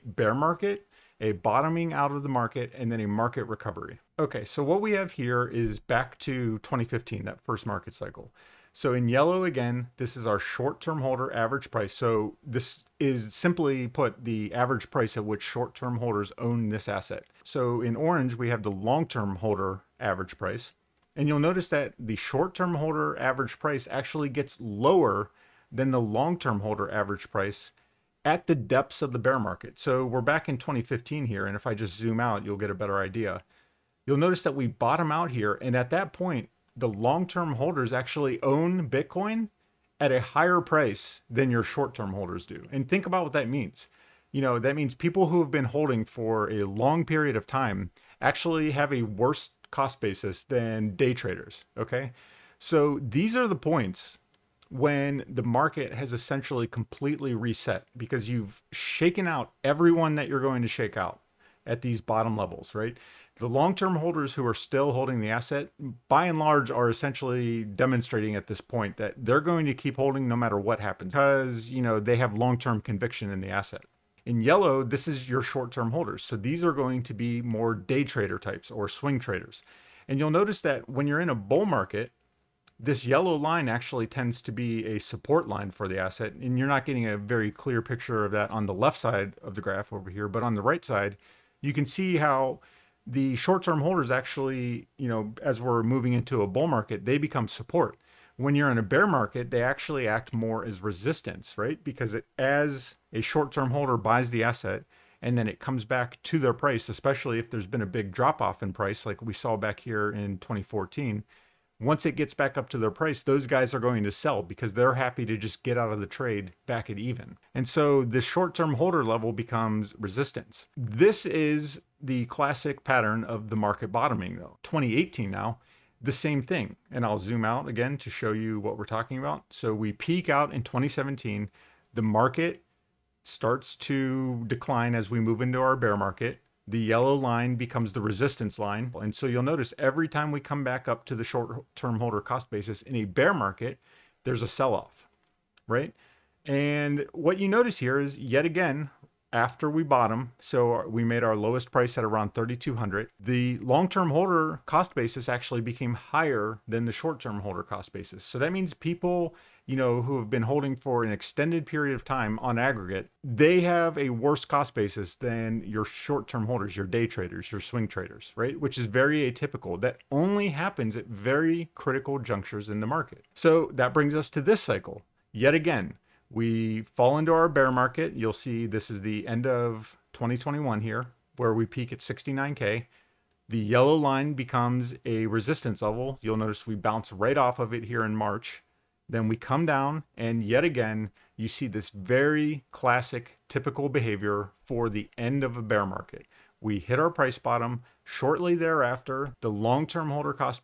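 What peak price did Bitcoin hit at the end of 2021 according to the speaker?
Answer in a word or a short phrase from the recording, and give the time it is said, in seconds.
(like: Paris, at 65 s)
69K, at 181 s.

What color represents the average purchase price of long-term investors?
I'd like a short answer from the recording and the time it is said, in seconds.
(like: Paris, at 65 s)
Orange, at 17 s.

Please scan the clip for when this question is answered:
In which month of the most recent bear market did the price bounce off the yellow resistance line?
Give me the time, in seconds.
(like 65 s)
188 s.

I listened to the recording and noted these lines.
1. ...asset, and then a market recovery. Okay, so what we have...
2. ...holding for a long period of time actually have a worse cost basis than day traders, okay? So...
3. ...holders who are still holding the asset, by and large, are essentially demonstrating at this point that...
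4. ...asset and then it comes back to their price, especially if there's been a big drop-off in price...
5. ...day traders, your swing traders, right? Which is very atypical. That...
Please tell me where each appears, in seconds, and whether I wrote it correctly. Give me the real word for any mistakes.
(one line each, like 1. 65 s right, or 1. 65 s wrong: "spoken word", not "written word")
1. 2 s wrong: "market", not "asset"
2. 45 s right
3. 63 s right
4. 104 s right
5. 166 s right.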